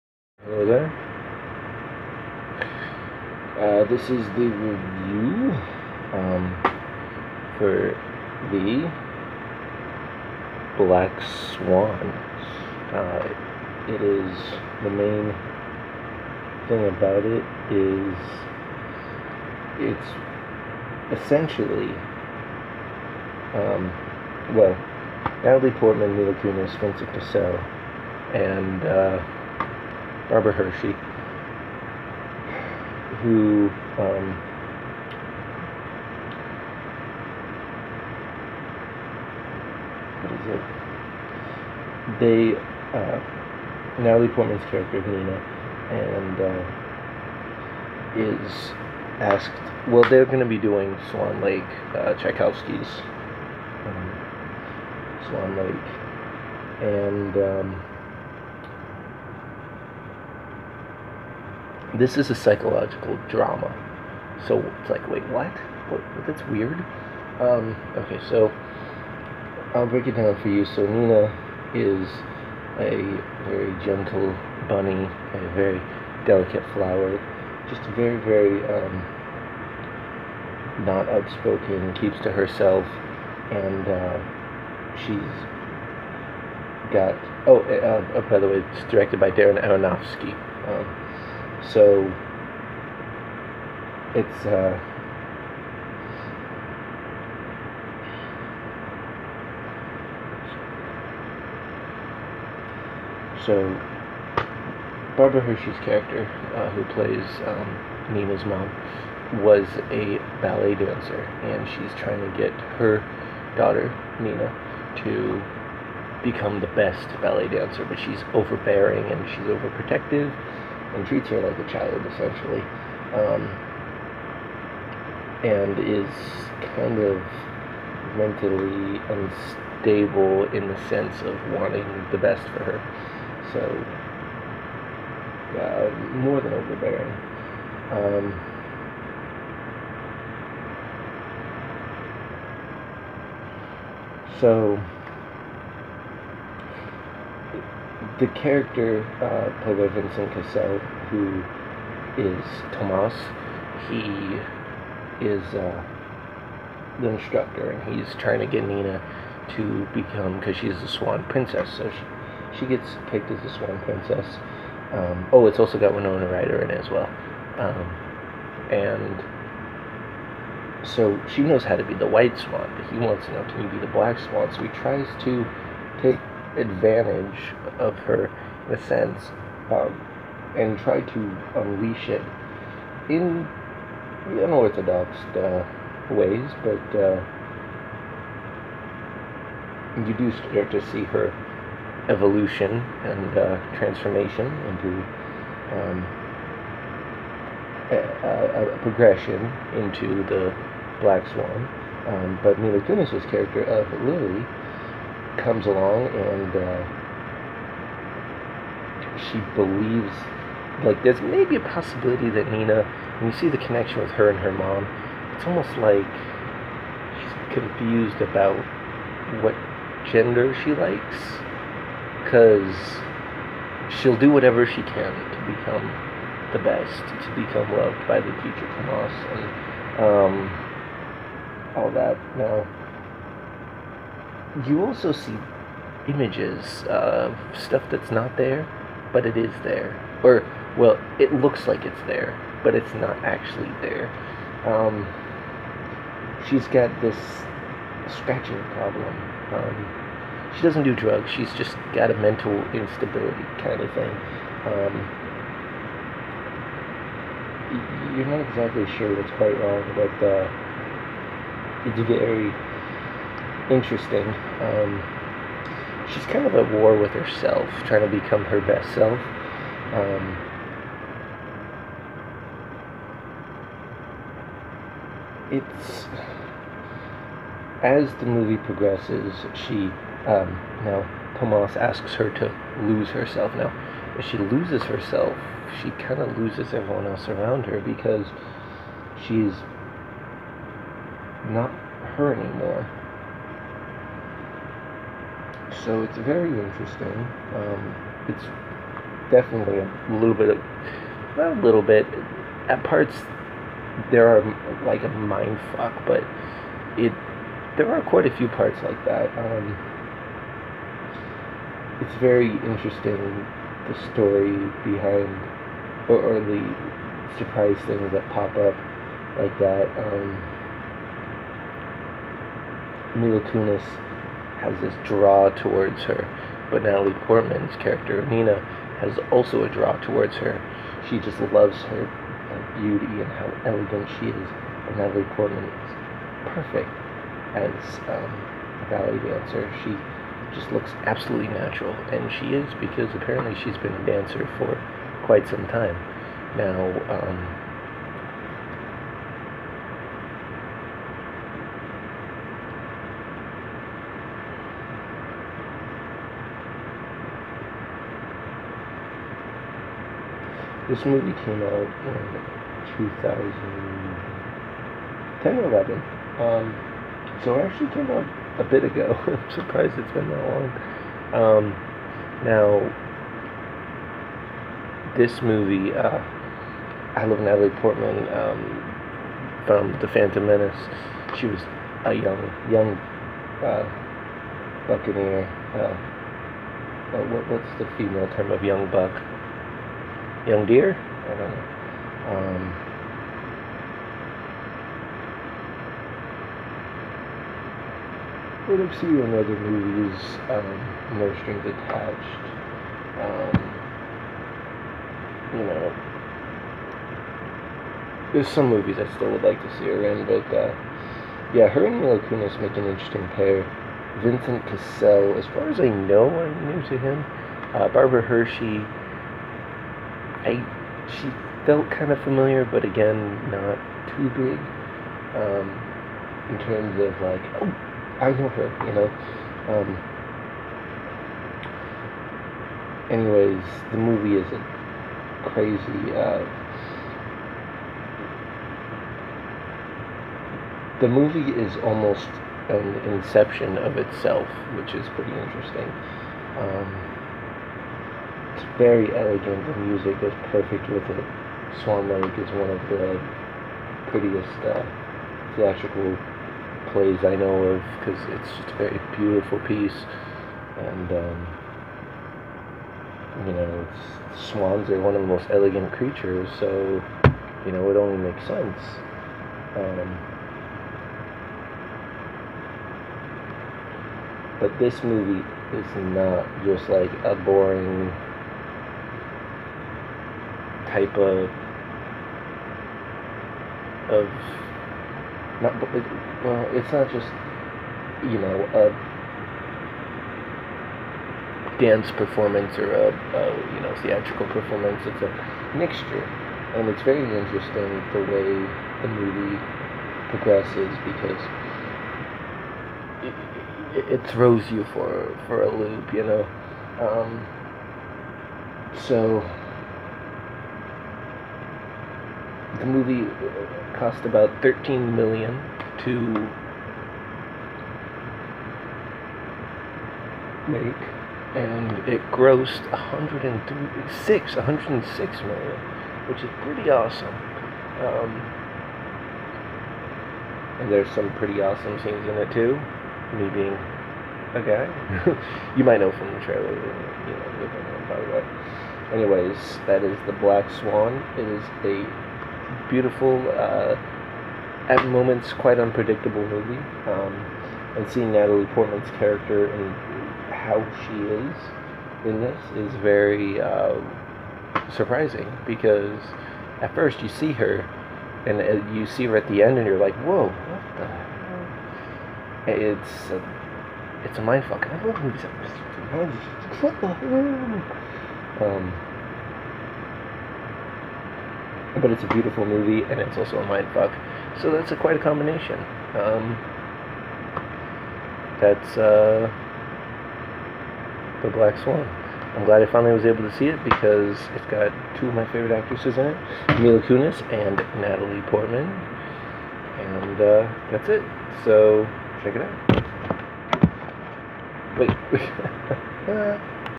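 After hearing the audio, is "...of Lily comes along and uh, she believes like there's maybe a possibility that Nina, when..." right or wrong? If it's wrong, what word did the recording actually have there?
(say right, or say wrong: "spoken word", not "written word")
right.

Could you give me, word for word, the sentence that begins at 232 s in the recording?
Now, you also see images of stuff that's not there, but it is there.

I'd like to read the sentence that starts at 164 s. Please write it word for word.
Um, oh, it's also got Winona Ryder in it as well.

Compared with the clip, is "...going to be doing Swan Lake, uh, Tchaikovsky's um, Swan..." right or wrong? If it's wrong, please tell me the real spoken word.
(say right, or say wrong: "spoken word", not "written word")
right.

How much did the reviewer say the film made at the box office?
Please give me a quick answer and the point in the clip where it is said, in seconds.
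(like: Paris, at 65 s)
106 million, at 524 s.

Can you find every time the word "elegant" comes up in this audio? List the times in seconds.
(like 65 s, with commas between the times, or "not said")
333 s, 449 s, 465 s.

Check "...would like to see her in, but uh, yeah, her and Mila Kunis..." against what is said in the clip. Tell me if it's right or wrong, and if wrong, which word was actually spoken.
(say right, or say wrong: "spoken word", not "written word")
right.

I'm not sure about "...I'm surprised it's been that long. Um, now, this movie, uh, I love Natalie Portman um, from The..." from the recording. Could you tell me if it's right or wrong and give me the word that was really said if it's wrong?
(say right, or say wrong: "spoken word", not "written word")
right.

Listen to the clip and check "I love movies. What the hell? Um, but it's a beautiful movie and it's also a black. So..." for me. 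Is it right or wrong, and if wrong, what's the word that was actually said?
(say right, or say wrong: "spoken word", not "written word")
wrong: "mindfuck", not "black".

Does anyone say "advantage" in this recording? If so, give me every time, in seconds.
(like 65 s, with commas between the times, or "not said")
176 s.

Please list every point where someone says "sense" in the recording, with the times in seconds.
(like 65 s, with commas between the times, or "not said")
130 s, 178 s, 468 s.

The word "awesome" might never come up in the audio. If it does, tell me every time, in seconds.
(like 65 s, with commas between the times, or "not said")
526 s, 531 s.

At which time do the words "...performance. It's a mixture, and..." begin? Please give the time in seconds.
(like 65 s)
494 s.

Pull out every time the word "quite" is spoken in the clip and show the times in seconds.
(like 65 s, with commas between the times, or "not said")
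259 s, 308 s, 345 s, 545 s, 574 s.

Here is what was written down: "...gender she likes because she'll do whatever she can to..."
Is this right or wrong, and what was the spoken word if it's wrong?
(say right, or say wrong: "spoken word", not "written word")
right.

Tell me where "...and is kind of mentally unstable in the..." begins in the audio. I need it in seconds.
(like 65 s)
125 s.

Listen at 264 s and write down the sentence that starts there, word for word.
Um, she's kind of at war with herself, trying to become her best self.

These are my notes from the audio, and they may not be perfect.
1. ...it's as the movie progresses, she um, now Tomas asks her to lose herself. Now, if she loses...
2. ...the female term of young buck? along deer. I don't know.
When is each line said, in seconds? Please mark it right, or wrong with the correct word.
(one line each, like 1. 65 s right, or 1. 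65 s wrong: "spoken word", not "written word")
1. 275 s right
2. 387 s wrong: "young", not "along".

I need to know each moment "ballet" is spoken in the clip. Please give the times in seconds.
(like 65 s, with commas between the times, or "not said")
110 s, 117 s, 338 s.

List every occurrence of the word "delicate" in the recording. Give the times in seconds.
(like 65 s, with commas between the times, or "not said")
76 s.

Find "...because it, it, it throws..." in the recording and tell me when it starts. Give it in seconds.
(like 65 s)
501 s.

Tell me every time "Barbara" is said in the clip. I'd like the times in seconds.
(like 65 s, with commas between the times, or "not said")
30 s, 105 s, 417 s.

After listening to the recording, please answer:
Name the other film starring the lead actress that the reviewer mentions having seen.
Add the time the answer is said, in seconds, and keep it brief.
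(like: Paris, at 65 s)
No Strings Attached, at 401 s.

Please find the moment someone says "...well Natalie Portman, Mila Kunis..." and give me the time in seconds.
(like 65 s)
24 s.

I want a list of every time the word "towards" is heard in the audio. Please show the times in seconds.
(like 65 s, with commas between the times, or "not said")
325 s, 330 s.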